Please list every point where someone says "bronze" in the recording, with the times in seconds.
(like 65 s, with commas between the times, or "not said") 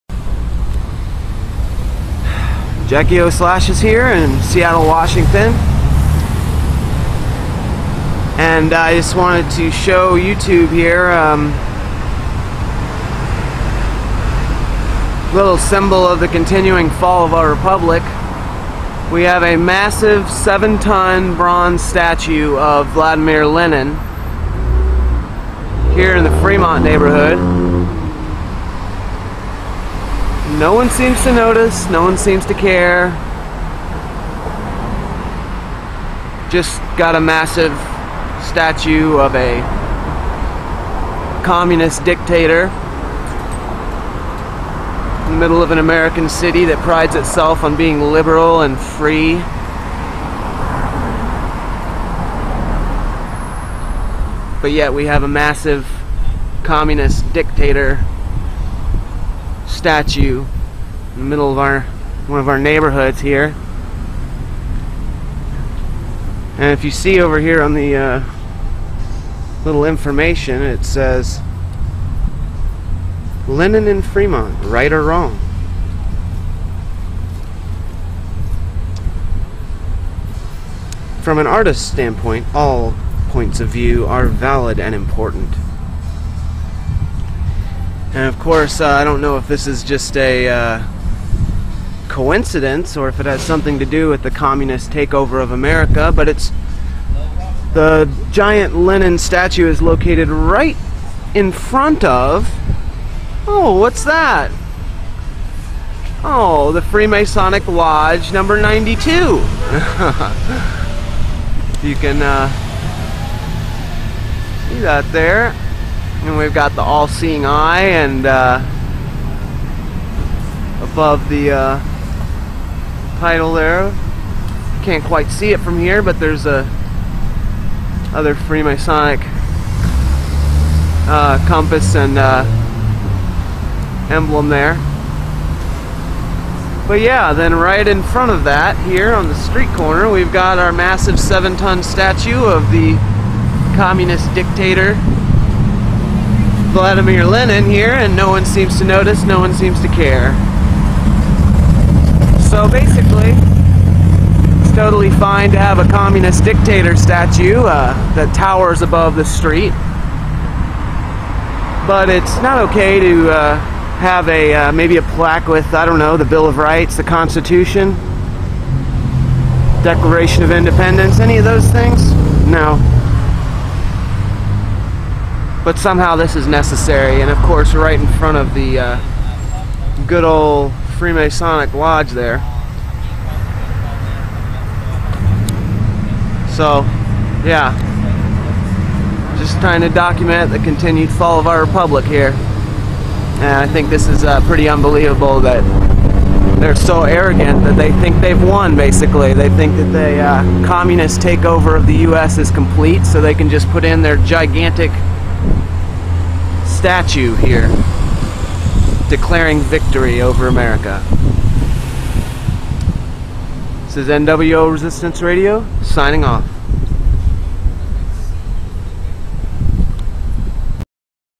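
21 s.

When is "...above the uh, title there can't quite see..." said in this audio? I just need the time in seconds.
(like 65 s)
120 s.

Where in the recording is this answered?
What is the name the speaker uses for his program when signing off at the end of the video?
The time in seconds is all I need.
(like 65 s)
214 s.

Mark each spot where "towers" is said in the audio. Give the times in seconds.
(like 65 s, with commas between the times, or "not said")
158 s.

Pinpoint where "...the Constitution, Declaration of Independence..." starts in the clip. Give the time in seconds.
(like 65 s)
166 s.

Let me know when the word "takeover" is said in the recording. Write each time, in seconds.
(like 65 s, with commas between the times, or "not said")
94 s, 201 s.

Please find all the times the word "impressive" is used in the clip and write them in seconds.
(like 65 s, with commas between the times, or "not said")
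not said.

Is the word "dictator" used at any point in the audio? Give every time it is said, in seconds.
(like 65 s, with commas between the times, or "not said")
42 s, 57 s, 144 s, 156 s.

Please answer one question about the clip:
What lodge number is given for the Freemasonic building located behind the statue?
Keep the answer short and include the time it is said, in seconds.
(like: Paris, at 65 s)
92, at 108 s.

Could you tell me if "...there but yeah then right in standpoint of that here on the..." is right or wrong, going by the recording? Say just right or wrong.
wrong.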